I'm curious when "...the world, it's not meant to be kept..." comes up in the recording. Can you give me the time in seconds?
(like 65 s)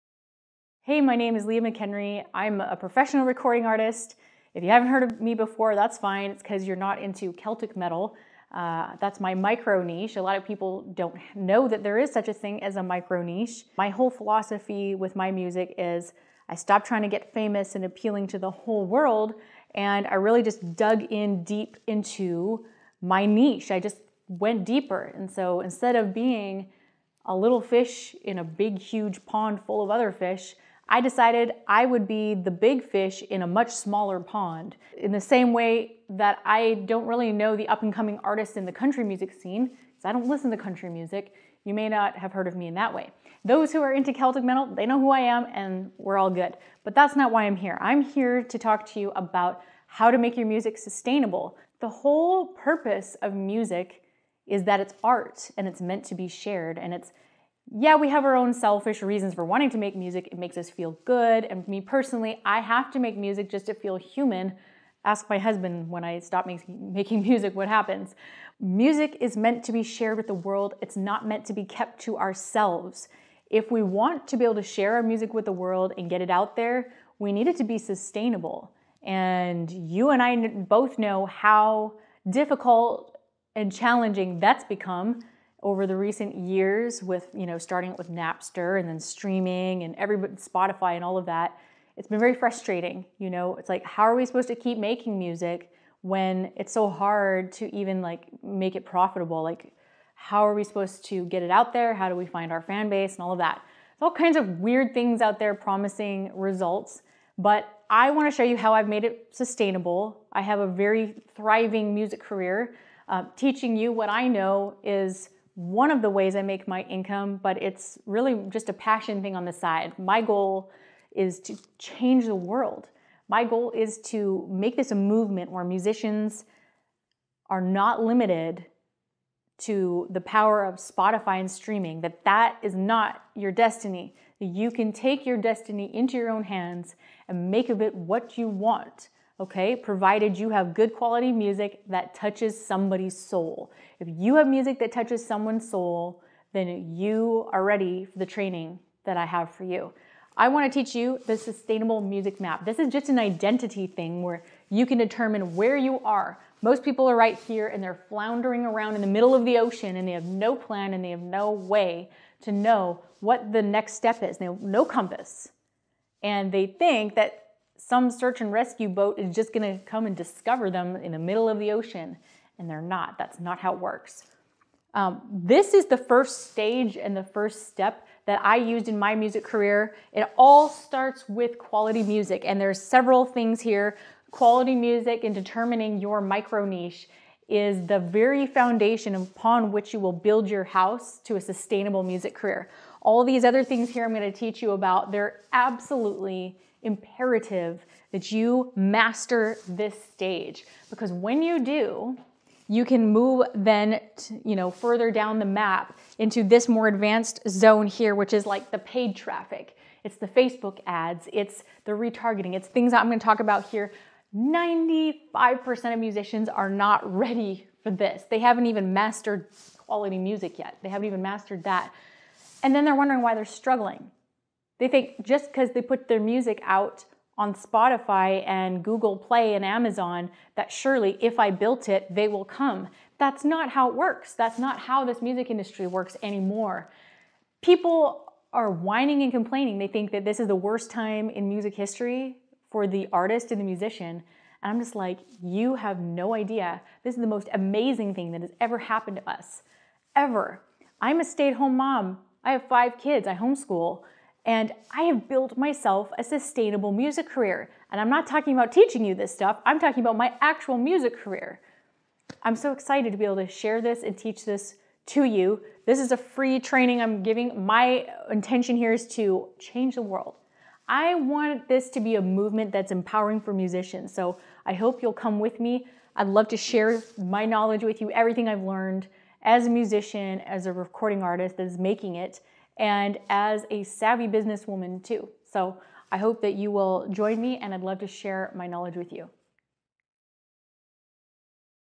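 70 s.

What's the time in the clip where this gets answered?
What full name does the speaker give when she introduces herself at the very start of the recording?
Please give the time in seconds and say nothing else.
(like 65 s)
1 s.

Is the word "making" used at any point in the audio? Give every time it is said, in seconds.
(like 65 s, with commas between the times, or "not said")
66 s, 94 s, 281 s.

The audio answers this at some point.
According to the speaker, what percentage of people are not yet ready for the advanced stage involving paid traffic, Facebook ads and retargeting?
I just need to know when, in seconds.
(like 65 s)
214 s.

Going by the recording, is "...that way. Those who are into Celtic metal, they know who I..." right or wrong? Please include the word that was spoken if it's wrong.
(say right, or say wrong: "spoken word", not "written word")
right.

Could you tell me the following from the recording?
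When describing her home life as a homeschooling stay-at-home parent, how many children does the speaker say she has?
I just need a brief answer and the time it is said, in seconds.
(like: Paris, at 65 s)
5, at 252 s.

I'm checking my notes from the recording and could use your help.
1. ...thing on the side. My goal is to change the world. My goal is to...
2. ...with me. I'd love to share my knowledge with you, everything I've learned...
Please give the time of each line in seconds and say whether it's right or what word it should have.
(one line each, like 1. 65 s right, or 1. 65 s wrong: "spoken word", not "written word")
1. 119 s right
2. 275 s right.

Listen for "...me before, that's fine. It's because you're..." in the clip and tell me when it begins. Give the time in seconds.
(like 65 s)
5 s.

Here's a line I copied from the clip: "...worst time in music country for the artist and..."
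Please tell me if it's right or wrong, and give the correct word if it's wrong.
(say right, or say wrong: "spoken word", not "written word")
wrong: "history", not "country".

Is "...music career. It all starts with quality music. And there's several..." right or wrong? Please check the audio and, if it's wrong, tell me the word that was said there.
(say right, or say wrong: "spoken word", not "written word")
right.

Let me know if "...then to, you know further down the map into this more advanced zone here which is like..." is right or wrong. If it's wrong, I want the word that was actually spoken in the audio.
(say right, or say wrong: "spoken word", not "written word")
right.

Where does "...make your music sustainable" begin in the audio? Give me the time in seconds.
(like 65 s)
50 s.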